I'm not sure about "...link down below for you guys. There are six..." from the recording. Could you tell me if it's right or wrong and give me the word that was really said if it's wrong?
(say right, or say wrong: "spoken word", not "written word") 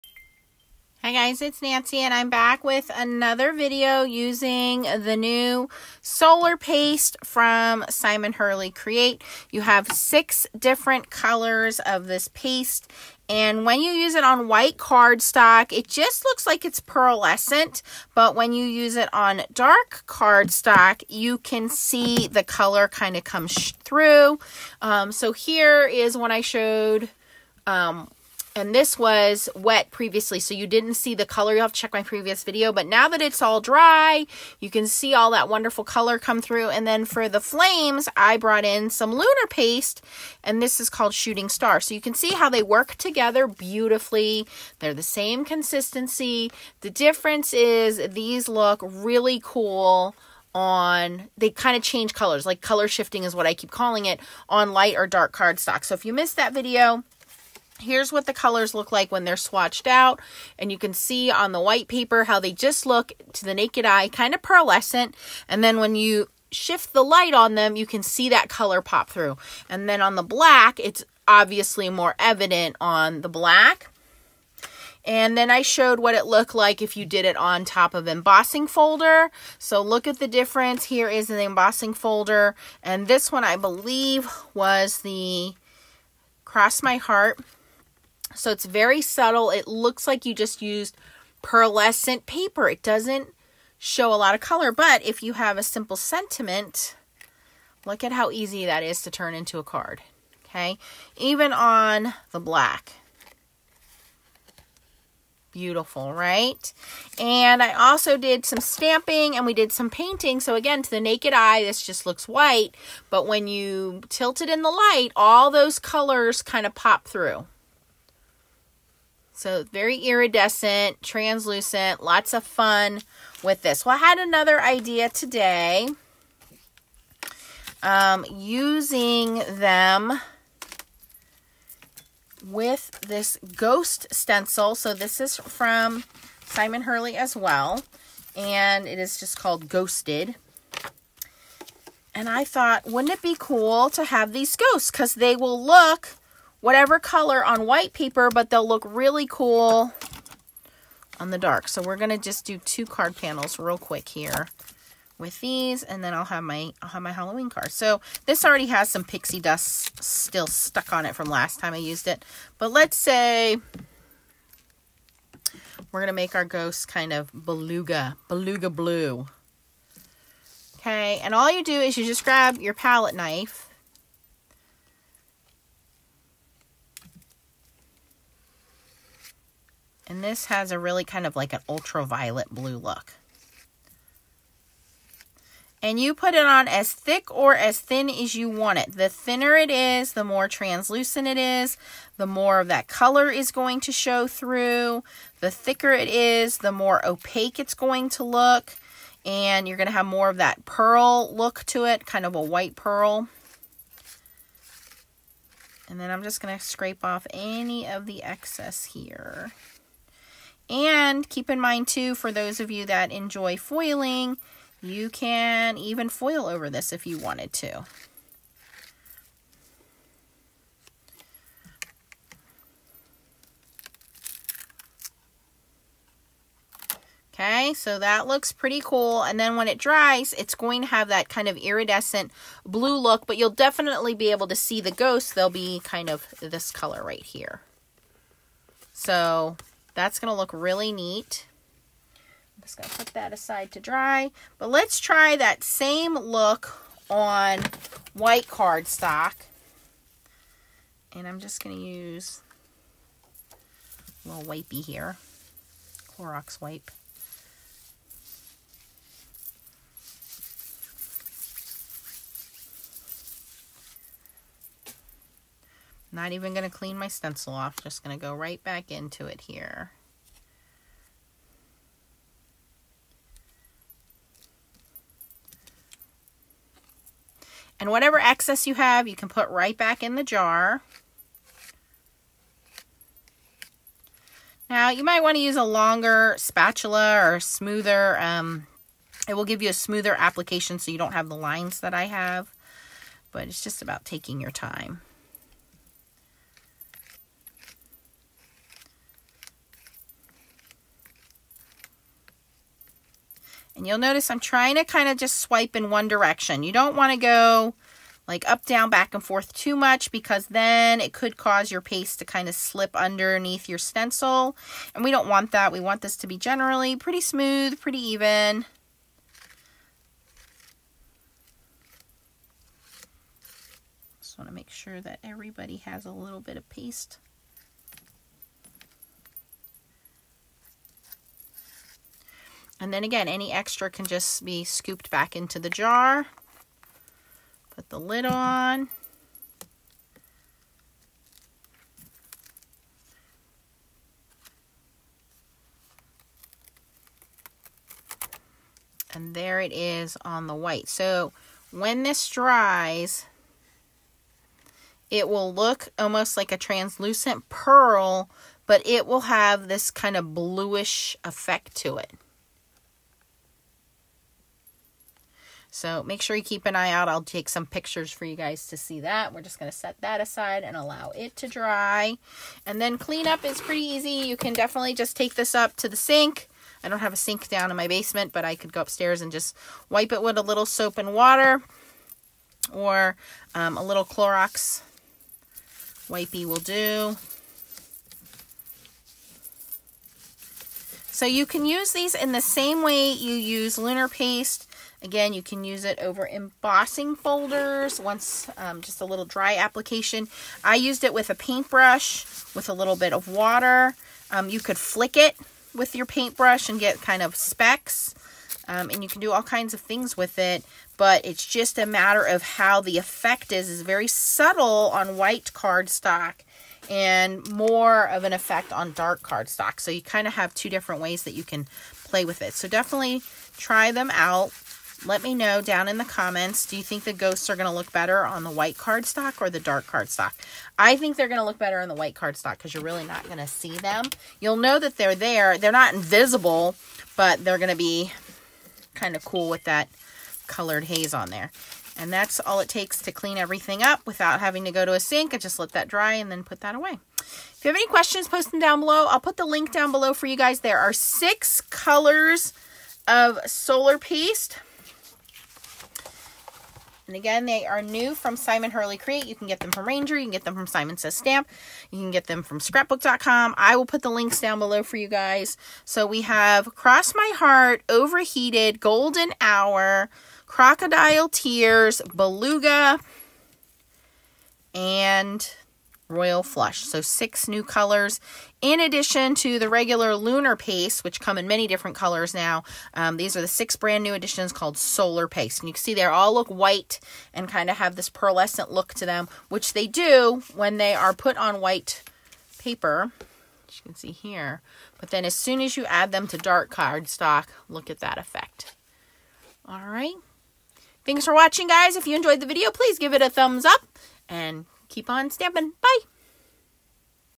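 right.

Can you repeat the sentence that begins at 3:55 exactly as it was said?
They'll be kind of this color right here.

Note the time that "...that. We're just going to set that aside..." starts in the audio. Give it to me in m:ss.
6:08.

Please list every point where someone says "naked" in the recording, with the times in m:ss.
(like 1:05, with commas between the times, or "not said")
1:03, 1:51.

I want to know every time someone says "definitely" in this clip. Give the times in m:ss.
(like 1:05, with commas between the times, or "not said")
3:53, 6:14, 7:02.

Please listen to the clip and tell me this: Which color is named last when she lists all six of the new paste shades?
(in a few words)
Royal Flush.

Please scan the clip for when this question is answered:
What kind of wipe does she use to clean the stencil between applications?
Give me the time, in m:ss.
4:16.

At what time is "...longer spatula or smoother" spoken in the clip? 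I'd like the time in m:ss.
4:45.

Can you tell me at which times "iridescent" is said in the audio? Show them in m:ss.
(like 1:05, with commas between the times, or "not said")
1:59, 3:51.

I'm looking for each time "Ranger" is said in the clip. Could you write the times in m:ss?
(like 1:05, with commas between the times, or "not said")
7:39.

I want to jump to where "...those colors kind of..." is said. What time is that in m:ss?
1:55.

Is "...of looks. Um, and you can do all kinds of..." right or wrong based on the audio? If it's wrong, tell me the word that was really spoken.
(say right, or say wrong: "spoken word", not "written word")
wrong: "specks", not "looks".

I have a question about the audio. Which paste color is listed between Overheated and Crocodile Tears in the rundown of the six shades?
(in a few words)
Golden Hour.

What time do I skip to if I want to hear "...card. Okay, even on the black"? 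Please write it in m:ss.
1:39.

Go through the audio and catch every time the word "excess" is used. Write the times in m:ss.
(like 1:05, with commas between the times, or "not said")
3:28, 4:38.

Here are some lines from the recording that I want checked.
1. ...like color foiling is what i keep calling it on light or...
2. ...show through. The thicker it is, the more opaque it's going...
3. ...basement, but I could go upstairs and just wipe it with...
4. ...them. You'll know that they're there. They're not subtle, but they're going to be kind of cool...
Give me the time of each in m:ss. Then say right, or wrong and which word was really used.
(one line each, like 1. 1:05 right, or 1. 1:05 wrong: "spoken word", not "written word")
1. 0:52 wrong: "shifting", not "foiling"
2. 3:13 right
3. 6:17 right
4. 7:13 wrong: "invisible", not "subtle".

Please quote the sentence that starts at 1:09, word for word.
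And then on the black, it's obviously more evident on the black.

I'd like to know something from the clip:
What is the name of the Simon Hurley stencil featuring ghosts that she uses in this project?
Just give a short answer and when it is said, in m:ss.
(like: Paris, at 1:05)
Ghosted, at 2:19.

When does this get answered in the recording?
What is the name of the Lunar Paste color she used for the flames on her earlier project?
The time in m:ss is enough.
0:41.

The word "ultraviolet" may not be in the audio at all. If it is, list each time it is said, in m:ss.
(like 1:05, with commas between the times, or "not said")
3:01.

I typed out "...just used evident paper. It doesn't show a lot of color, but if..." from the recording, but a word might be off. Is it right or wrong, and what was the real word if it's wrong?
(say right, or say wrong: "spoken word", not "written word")
wrong: "pearlescent", not "evident".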